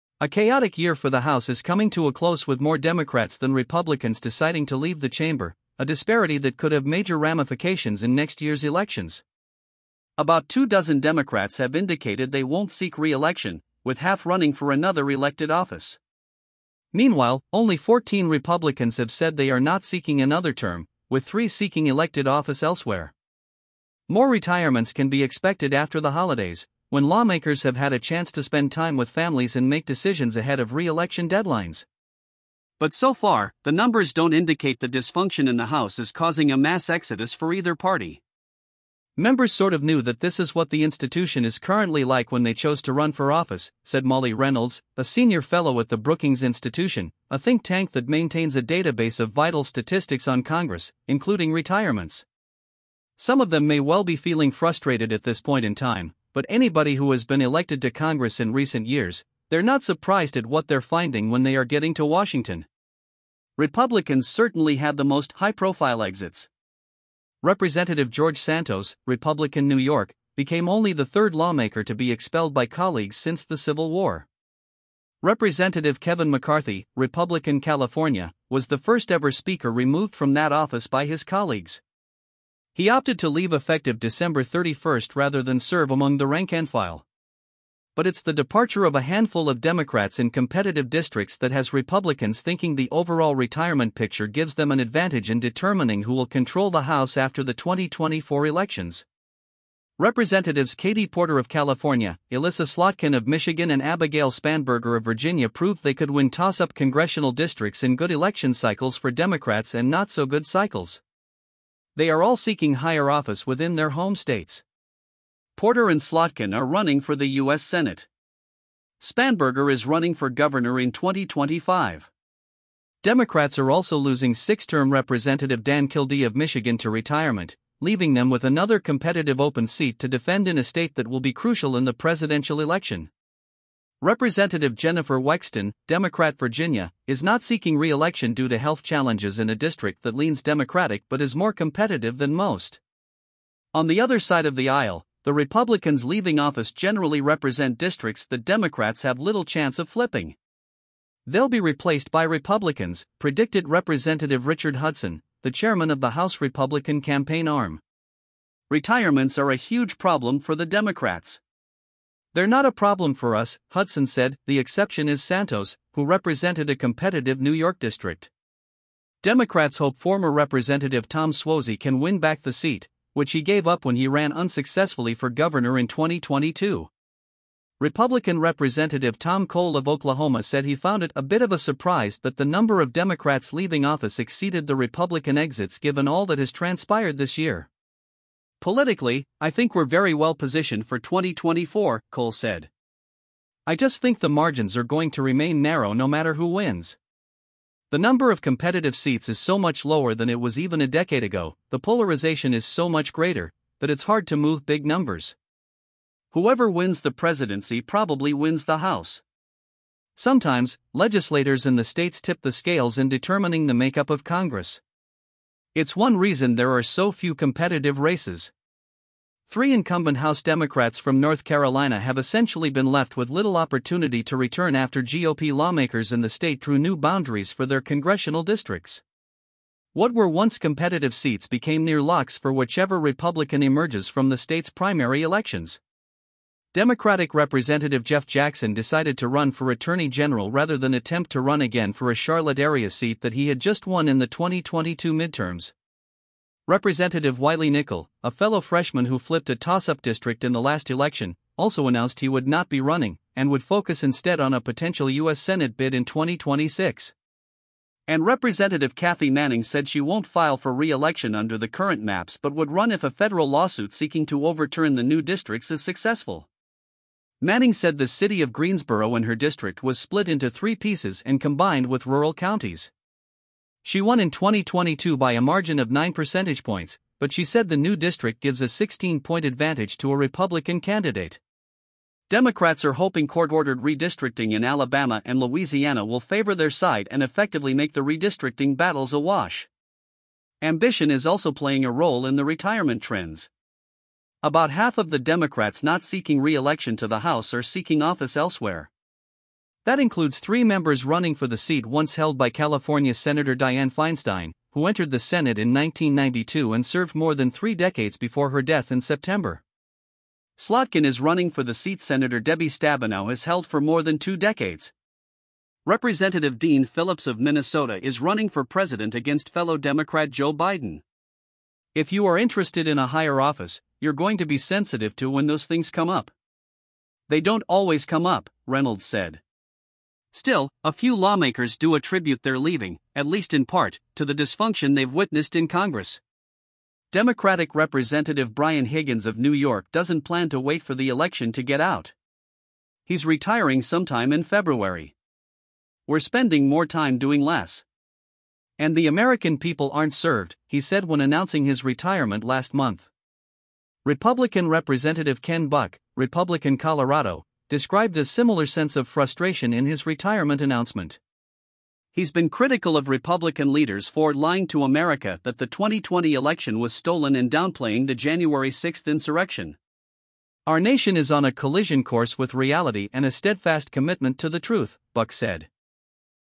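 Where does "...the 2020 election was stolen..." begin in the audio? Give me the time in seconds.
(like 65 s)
365 s.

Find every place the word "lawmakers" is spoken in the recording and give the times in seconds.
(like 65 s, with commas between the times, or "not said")
27 s, 71 s, 225 s, 331 s.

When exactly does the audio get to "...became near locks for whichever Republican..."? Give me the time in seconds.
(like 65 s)
231 s.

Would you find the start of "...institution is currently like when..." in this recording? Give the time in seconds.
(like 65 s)
40 s.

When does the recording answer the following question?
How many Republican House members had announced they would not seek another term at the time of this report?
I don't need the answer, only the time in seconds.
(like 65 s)
17 s.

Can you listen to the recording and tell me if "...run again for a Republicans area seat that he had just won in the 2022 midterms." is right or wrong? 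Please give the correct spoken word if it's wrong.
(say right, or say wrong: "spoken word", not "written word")
wrong: "Charlotte", not "Republicans".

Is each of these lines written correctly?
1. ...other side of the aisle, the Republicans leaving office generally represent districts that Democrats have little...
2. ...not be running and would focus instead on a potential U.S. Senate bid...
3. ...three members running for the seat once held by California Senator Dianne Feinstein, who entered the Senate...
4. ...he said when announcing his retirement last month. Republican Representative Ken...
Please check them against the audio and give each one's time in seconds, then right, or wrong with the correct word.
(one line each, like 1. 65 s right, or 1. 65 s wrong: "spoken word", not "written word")
1. 144 s right
2. 252 s right
3. 300 s right
4. 350 s right.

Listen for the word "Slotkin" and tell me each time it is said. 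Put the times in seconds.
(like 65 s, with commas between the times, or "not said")
102 s, 115 s, 310 s.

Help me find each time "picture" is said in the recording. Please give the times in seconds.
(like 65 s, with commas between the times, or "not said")
93 s.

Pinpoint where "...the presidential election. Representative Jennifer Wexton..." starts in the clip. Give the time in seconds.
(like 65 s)
131 s.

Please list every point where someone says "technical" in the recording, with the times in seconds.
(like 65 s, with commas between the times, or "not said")
not said.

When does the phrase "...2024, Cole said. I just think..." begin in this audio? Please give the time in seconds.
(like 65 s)
190 s.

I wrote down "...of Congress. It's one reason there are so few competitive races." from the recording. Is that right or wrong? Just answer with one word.
right.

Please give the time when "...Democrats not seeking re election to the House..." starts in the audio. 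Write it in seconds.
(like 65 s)
295 s.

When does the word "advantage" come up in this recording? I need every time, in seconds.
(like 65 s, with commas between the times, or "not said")
94 s, 279 s.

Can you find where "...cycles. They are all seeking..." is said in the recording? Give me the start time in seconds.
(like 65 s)
110 s.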